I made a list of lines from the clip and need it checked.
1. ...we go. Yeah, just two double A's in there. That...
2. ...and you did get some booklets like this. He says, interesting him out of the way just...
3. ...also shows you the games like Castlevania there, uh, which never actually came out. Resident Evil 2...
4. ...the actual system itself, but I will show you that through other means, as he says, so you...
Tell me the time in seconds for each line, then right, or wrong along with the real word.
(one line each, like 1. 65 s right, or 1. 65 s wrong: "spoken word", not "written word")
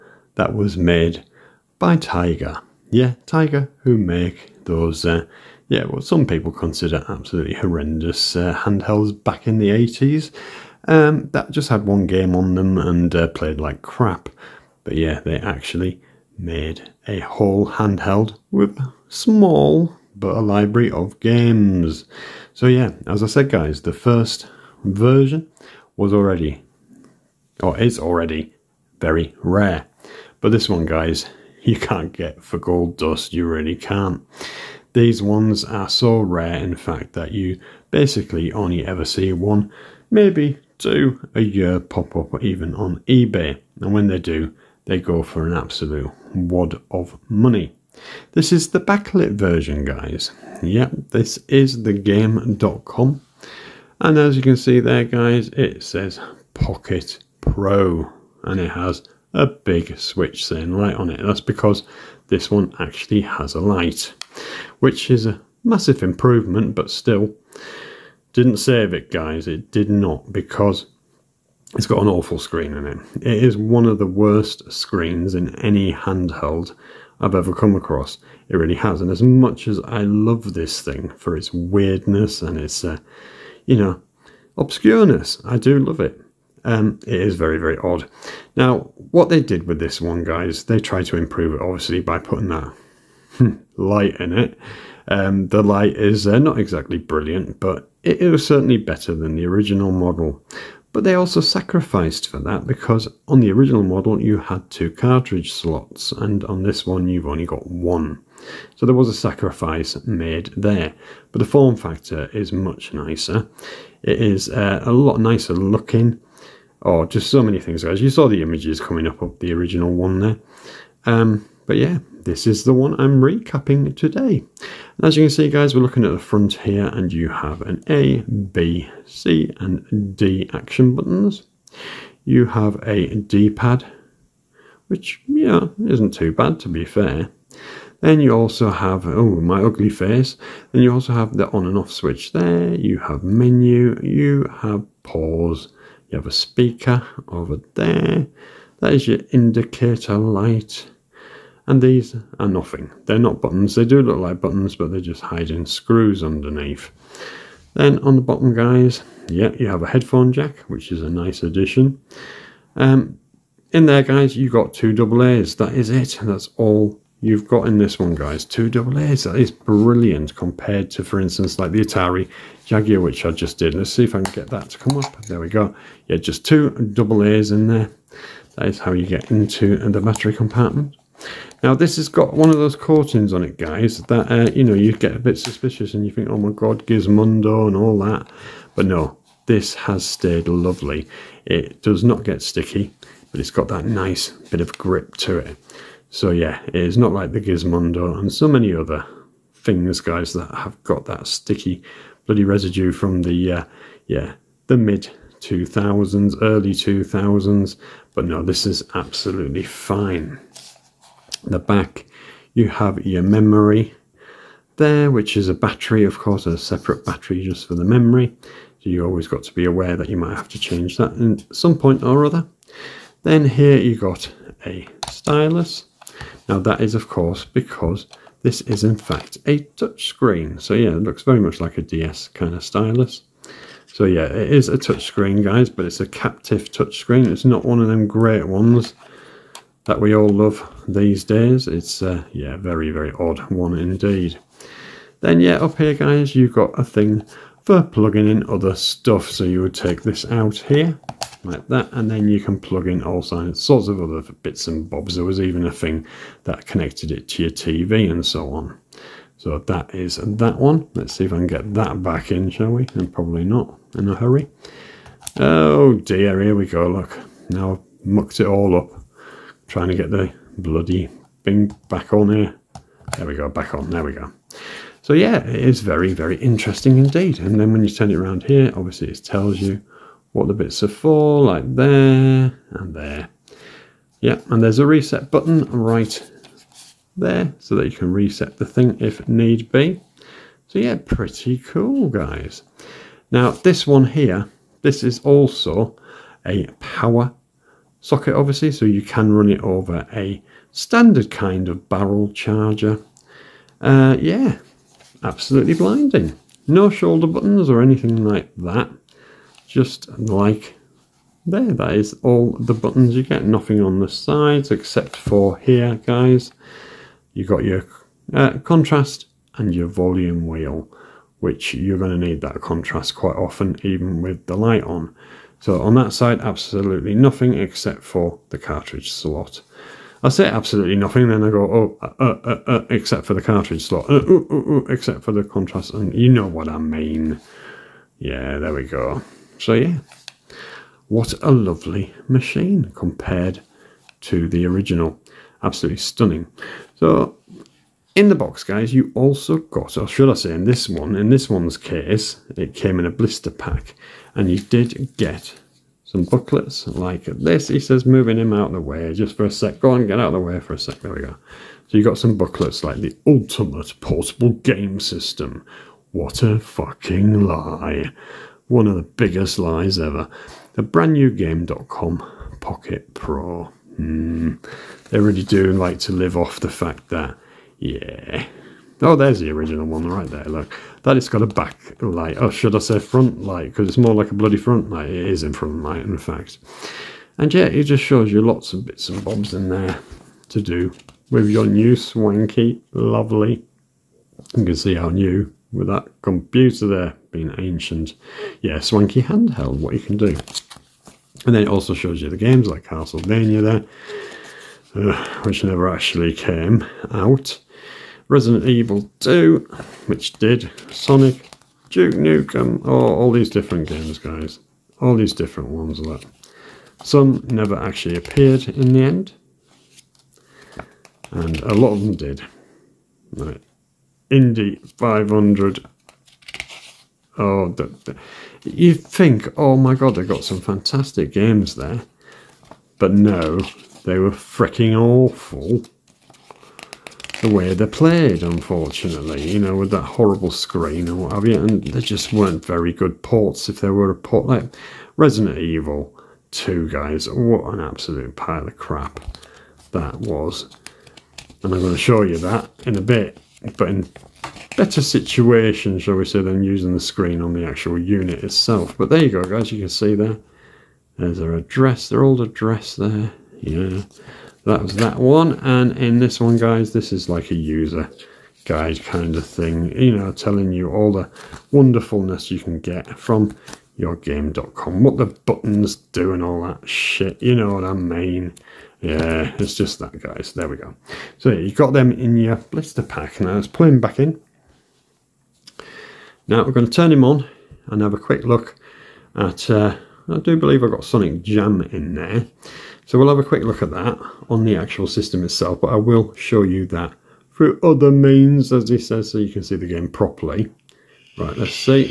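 1. 175 s right
2. 354 s wrong: "moving", not "interesting"
3. 401 s right
4. 494 s right.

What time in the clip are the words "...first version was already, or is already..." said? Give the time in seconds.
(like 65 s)
23 s.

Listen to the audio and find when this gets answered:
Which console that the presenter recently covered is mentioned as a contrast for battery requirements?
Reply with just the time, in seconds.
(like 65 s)
171 s.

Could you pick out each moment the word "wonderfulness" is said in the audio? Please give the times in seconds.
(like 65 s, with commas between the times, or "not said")
471 s.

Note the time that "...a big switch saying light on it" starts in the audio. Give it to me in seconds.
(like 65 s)
59 s.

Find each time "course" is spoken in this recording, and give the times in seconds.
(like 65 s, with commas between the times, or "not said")
216 s, 227 s.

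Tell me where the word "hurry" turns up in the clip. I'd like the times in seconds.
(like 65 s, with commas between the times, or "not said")
264 s.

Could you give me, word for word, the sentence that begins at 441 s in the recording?
And they just weren't very good ports if they were a port.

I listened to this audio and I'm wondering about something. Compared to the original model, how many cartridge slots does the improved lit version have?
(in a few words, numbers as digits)
1.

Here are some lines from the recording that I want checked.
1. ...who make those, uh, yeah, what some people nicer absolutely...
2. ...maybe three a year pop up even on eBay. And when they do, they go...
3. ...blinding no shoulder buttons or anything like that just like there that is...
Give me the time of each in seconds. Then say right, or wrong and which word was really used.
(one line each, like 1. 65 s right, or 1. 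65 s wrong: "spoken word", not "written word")
1. 3 s wrong: "consider", not "nicer"
2. 40 s wrong: "two", not "three"
3. 305 s right.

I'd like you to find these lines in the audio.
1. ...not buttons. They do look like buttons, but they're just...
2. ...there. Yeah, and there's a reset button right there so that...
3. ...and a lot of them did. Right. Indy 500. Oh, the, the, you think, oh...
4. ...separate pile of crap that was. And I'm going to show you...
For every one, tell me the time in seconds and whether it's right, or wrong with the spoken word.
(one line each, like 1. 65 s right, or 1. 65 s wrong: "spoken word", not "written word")
1. 153 s right
2. 282 s right
3. 421 s right
4. 447 s wrong: "absolute", not "separate".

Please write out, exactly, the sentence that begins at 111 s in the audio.
But the form factor is much nicer.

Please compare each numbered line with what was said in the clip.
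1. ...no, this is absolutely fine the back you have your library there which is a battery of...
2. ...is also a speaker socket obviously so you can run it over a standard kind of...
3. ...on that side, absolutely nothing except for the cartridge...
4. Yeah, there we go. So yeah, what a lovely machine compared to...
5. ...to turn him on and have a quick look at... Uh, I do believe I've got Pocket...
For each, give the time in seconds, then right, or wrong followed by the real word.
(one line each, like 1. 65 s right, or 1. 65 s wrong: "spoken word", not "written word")
1. 208 s wrong: "memory", not "library"
2. 295 s wrong: "power", not "speaker"
3. 325 s right
4. 338 s right
5. 486 s wrong: "Sonic", not "Pocket".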